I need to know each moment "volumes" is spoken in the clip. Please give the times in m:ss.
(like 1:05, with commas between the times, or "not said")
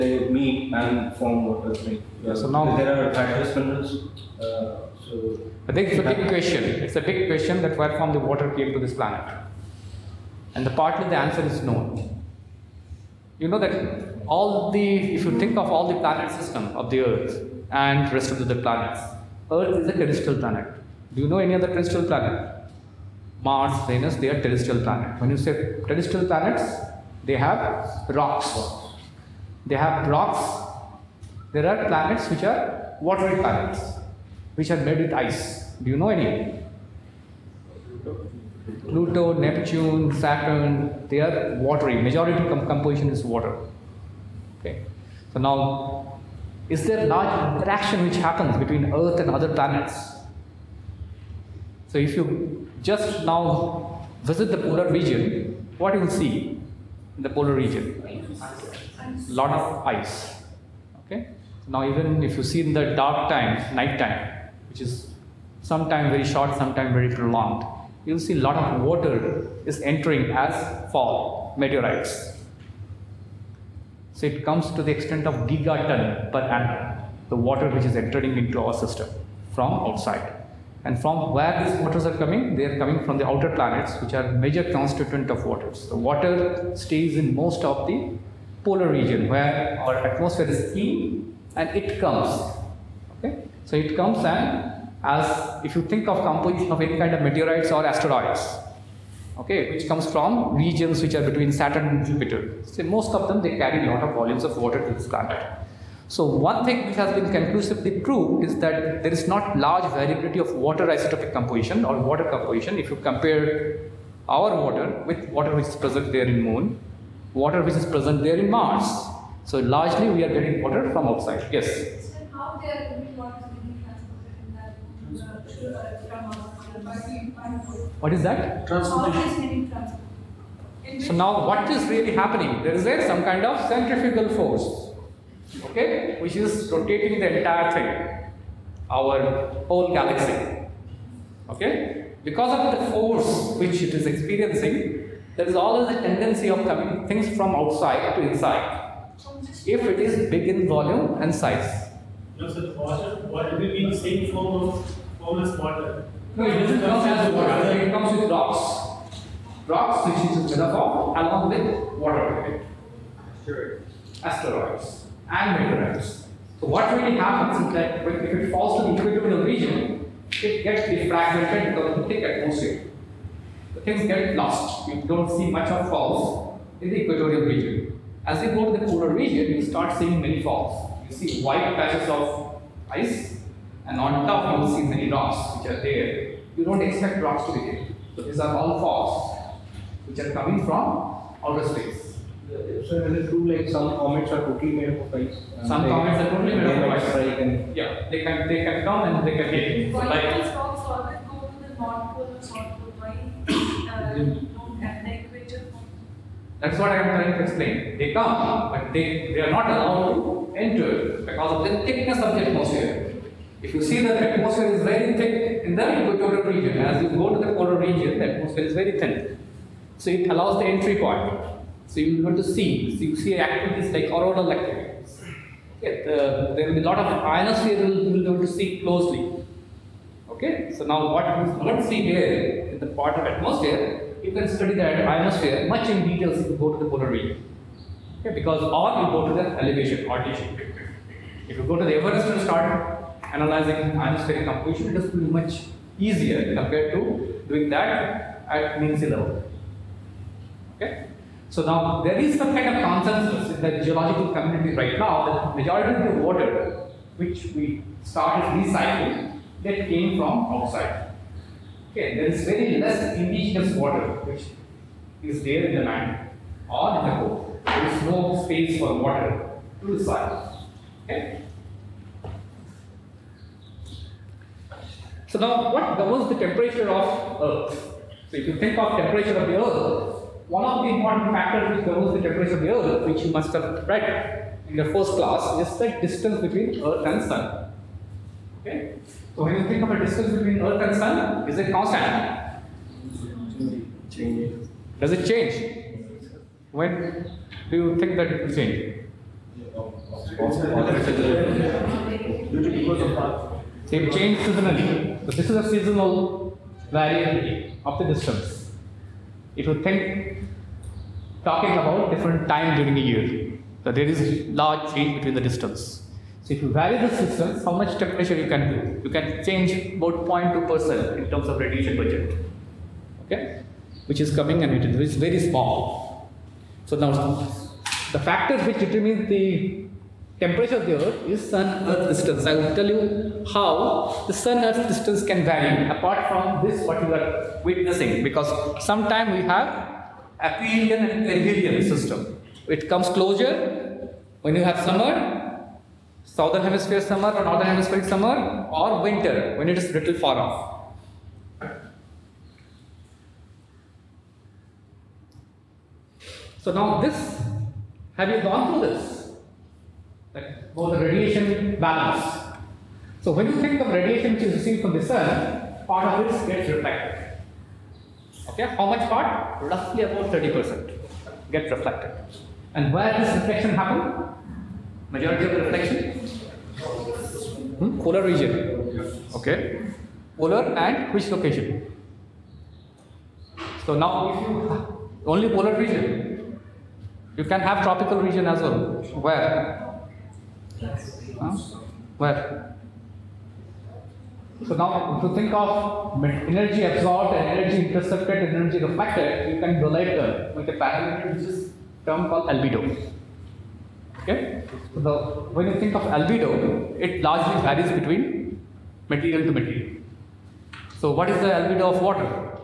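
1:44, 2:30.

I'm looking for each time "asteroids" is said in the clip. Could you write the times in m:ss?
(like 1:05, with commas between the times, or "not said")
1:37, 2:44.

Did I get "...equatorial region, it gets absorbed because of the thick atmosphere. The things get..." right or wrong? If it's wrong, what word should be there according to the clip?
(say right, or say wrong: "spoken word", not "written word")
wrong: "defragmented", not "absorbed".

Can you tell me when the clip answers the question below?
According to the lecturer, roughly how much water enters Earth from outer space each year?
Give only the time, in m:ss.
1:15.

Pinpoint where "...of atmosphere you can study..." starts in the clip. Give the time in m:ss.
3:53.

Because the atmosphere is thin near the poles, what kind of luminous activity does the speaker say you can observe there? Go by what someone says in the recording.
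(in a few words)
auroral activities.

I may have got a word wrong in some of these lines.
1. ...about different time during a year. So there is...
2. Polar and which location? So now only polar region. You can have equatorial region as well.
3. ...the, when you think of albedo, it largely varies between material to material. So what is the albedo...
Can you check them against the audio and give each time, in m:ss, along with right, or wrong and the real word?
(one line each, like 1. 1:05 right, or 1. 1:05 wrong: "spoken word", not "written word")
1. 5:11 right
2. 6:20 wrong: "tropical", not "equatorial"
3. 6:45 right.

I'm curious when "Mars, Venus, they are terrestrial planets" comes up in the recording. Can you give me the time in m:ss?
0:23.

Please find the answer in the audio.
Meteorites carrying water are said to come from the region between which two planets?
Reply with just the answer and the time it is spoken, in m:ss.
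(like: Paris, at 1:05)
Saturn and Jupiter, at 1:41.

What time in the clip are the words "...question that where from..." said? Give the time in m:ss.
0:07.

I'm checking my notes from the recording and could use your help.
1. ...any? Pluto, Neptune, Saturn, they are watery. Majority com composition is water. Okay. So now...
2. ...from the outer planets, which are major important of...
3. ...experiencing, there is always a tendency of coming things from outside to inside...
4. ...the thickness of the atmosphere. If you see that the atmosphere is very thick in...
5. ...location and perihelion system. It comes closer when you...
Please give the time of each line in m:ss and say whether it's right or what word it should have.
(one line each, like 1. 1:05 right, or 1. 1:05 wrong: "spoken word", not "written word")
1. 0:36 right
2. 1:23 wrong: "constituent", not "important"
3. 2:24 right
4. 3:31 right
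5. 5:40 wrong: "aphelion", not "location".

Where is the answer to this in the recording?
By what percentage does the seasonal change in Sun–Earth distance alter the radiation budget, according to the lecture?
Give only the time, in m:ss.
5:20.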